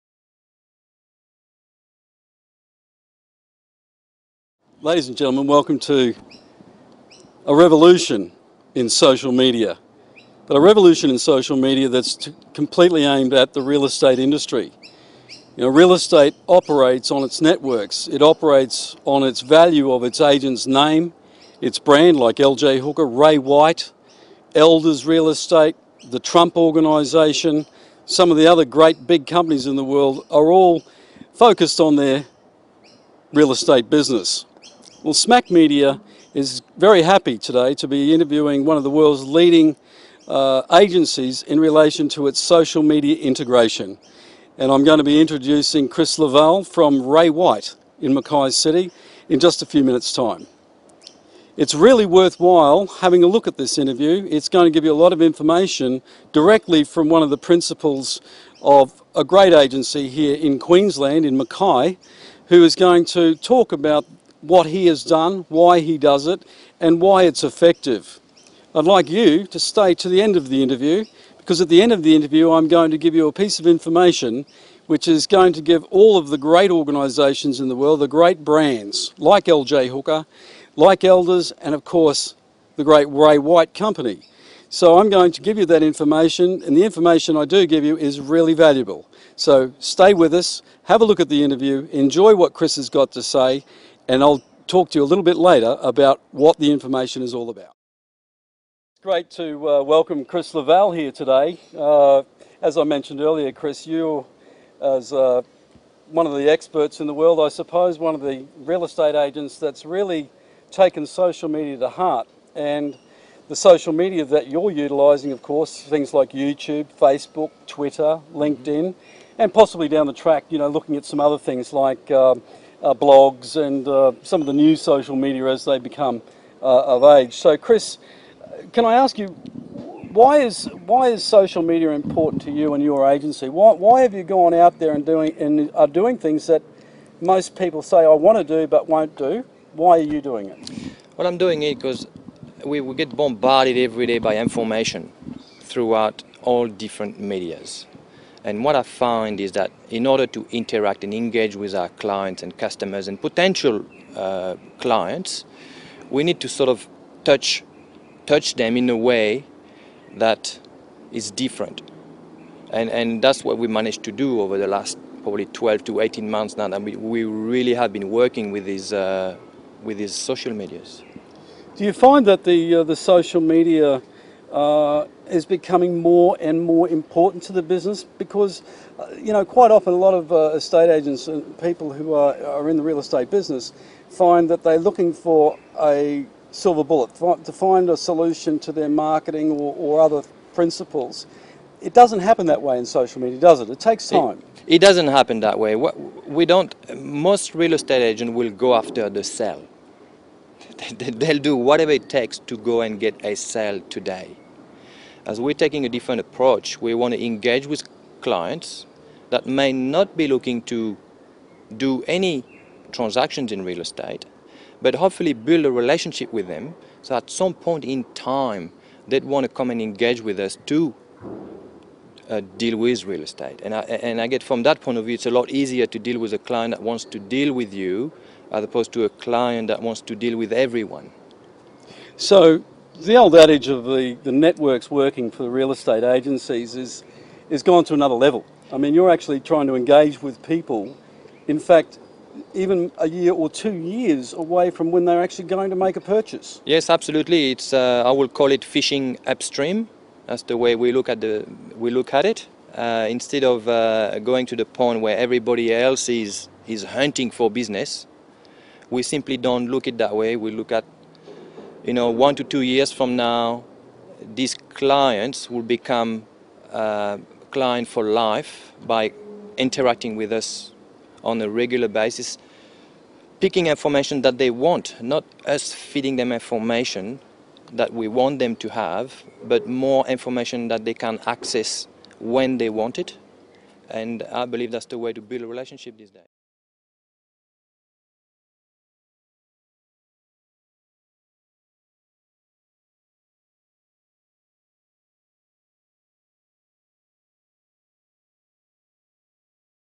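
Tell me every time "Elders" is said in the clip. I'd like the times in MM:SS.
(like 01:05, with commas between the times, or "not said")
00:24, 01:21.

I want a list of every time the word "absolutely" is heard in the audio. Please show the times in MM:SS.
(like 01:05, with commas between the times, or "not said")
04:06.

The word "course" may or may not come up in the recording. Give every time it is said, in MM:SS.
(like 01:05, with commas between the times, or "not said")
01:21, 01:55.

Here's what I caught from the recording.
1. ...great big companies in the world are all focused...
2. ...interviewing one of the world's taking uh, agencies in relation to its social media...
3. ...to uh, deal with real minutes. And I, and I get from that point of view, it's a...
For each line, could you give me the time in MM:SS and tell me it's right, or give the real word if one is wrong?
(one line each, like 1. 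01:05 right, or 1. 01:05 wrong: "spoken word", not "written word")
1. 00:28 right
2. 00:38 wrong: "leading", not "taking"
3. 03:40 wrong: "estate", not "minutes".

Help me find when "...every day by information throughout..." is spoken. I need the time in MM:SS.
02:23.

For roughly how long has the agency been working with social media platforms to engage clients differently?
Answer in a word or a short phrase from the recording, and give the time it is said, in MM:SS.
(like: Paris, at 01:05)
12 to 18 months, at 02:45.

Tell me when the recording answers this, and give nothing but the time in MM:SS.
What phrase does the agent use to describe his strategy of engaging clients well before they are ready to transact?
04:08.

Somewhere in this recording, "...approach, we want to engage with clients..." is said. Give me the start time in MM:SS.
03:26.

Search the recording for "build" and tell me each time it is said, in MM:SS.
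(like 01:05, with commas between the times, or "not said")
03:35, 04:45.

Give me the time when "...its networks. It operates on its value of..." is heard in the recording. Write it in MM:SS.
00:17.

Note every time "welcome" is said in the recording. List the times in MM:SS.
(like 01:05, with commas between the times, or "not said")
00:05, 01:39.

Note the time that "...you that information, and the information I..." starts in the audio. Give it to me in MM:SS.
01:25.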